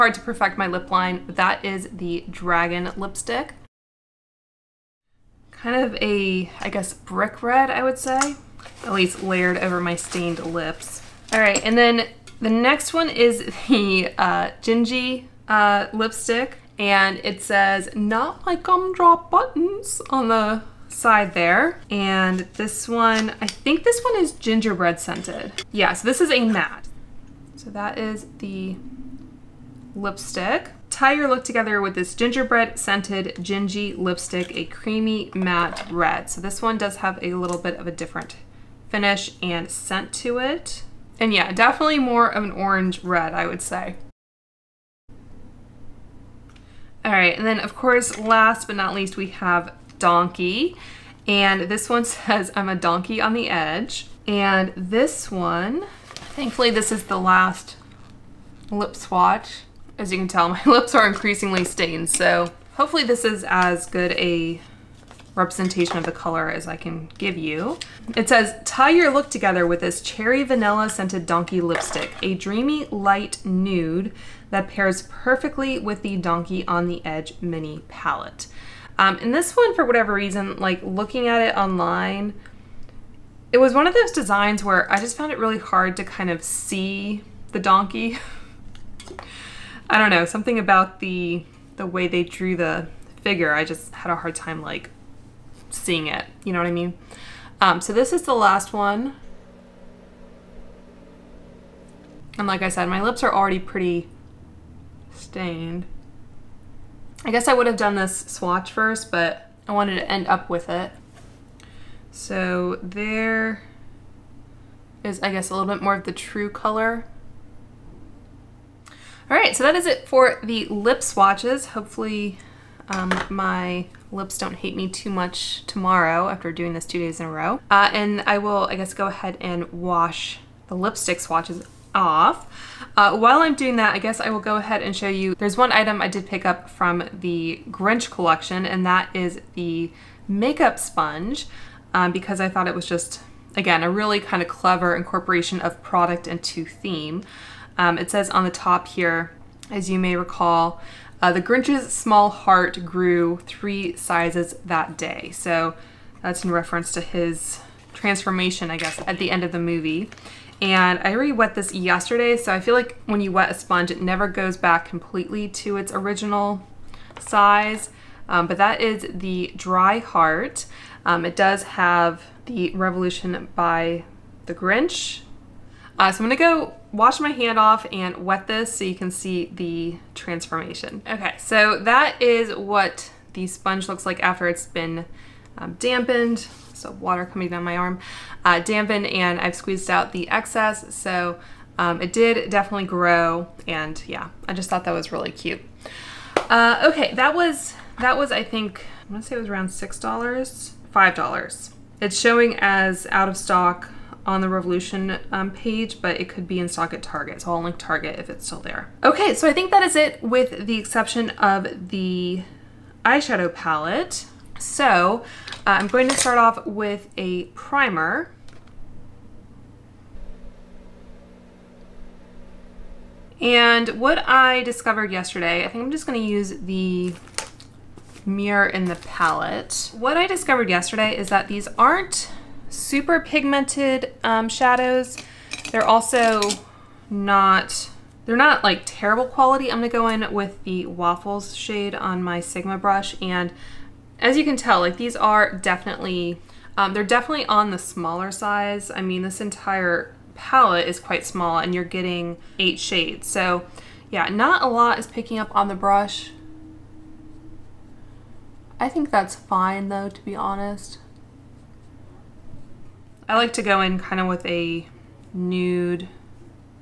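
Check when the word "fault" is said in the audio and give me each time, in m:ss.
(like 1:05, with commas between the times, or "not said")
not said.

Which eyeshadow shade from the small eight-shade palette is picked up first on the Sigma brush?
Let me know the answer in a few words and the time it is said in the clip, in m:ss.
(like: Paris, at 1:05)
Waffles, at 4:00.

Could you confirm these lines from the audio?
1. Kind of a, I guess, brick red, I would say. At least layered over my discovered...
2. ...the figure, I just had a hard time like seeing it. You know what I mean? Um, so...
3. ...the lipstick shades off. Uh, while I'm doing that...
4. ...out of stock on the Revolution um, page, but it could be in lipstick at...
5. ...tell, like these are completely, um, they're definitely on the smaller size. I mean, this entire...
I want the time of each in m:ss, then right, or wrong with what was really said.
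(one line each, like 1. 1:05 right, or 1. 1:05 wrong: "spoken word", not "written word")
1. 0:05 wrong: "stained", not "discovered"
2. 1:32 right
3. 2:10 wrong: "swatches", not "shades"
4. 3:23 wrong: "stock", not "lipstick"
5. 4:04 wrong: "definitely", not "completely".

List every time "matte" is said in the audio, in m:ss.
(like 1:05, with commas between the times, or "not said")
0:26, 0:35.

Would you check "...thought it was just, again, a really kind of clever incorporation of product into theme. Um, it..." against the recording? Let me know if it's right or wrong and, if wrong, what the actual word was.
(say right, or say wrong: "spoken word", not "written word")
right.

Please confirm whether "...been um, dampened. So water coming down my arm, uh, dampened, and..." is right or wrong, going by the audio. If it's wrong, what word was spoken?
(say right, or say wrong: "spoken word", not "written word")
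right.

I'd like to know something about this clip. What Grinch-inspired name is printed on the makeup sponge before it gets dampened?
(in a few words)
Dry Heart.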